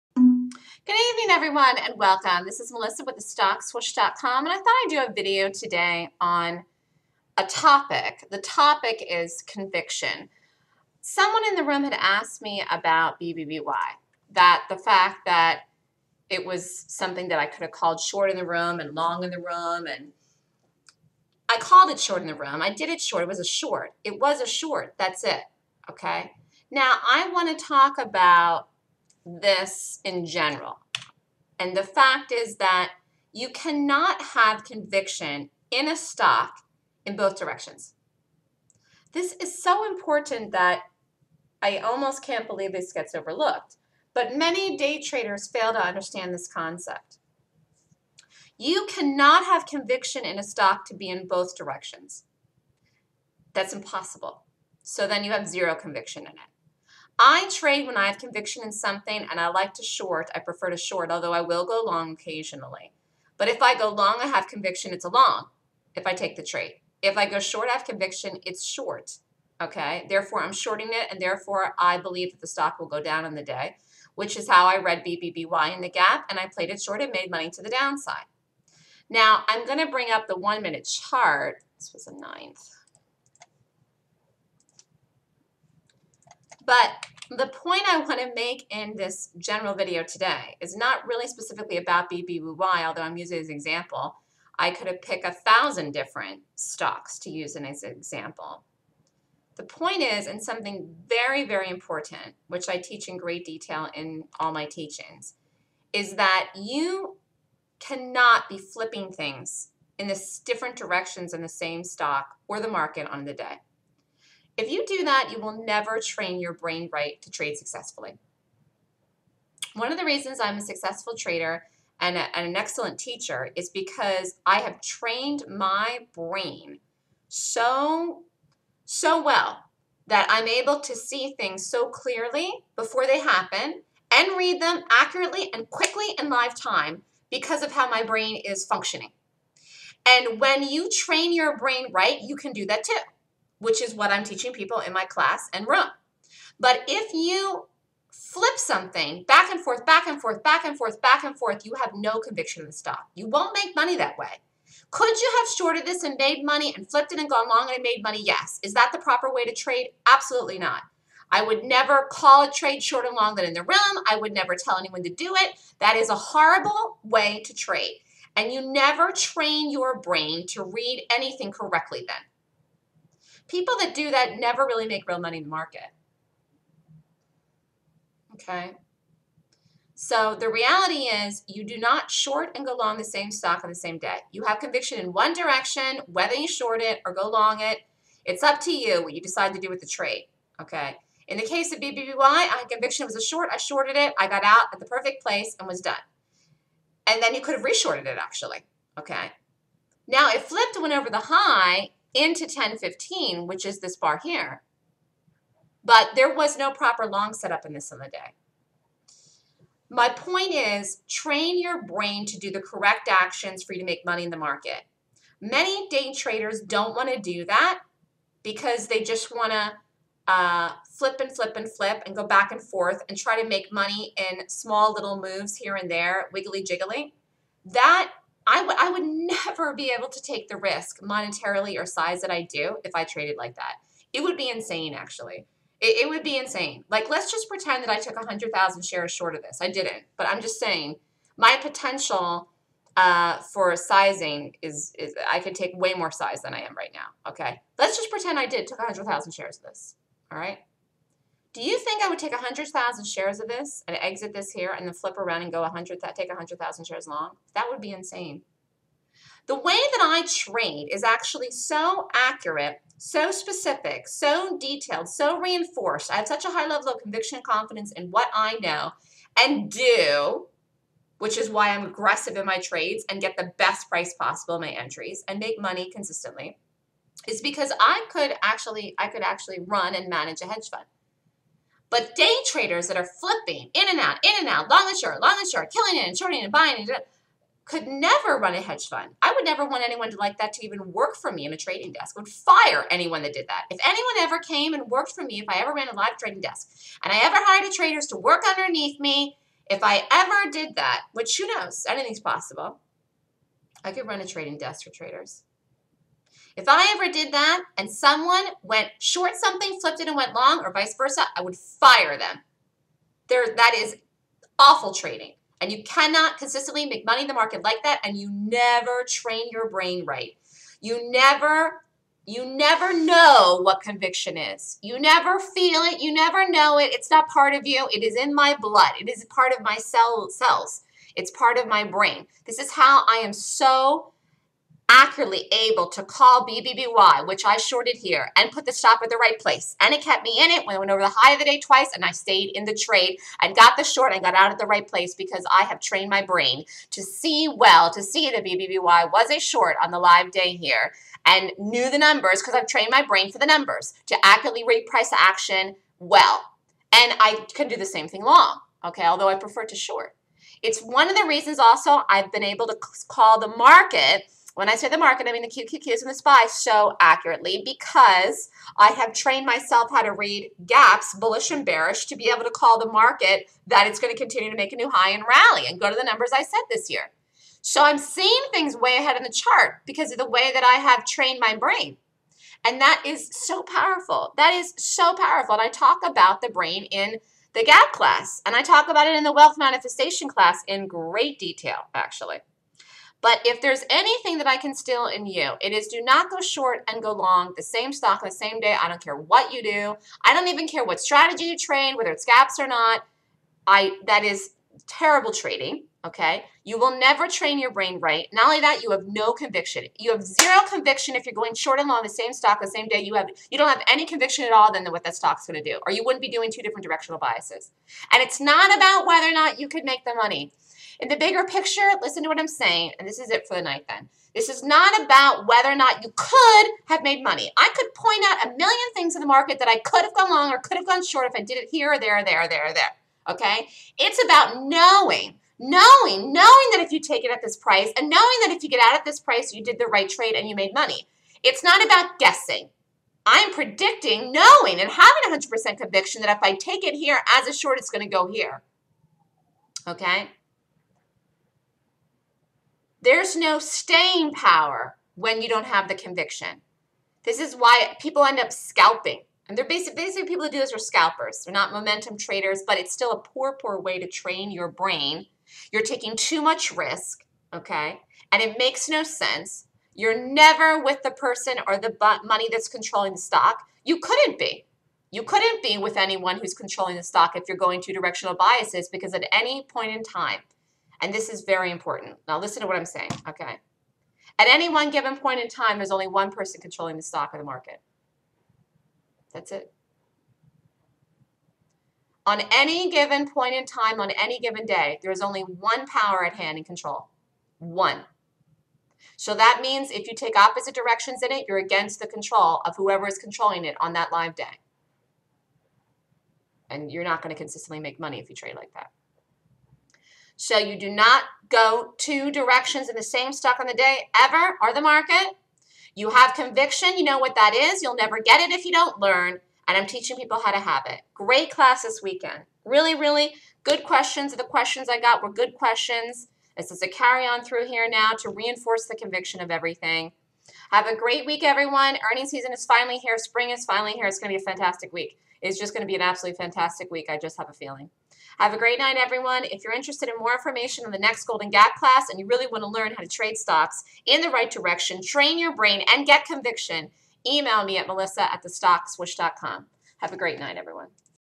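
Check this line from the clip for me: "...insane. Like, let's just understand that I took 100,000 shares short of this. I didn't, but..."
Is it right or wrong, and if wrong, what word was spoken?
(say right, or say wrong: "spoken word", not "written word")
wrong: "pretend", not "understand".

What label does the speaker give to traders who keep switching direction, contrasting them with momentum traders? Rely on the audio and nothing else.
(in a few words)
scalpers.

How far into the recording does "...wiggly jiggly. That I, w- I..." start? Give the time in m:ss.
3:46.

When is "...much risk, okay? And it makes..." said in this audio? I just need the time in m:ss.
7:46.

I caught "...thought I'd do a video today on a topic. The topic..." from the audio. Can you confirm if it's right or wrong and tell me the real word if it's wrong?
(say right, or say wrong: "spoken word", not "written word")
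right.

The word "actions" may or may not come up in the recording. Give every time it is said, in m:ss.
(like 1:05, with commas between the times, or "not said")
3:33, 5:55.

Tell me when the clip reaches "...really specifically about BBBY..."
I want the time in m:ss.
1:31.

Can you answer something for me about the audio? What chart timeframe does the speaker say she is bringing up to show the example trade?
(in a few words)
one minute.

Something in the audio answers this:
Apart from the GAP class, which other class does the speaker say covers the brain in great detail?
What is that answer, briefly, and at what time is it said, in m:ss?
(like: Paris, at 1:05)
wealth manifestation class, at 6:29.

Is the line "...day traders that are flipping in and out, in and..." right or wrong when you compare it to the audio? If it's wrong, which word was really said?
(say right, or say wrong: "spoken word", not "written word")
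right.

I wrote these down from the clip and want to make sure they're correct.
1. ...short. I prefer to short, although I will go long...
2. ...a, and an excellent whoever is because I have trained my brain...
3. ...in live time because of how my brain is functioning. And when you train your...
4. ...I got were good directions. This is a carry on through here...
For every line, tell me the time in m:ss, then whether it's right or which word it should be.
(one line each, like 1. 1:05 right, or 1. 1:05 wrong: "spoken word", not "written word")
1. 0:59 right
2. 2:02 wrong: "teacher", not "whoever"
3. 2:16 right
4. 8:44 wrong: "questions", not "directions".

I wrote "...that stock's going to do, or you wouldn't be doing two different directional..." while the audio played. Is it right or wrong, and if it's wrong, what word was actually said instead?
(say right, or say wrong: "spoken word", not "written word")
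right.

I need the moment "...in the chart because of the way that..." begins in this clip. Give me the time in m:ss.
6:19.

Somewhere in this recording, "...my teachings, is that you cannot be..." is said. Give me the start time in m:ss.
1:44.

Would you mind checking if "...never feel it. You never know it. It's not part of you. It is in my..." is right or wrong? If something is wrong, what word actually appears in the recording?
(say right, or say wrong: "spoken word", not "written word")
right.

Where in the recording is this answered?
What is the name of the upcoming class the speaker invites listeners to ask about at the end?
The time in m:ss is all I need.
9:01.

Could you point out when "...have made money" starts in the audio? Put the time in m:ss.
7:06.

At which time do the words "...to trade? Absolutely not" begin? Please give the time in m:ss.
2:39.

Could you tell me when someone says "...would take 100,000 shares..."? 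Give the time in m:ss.
4:12.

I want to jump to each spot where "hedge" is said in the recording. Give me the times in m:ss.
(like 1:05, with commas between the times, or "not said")
4:40, 4:48.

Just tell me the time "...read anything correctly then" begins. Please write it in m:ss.
2:50.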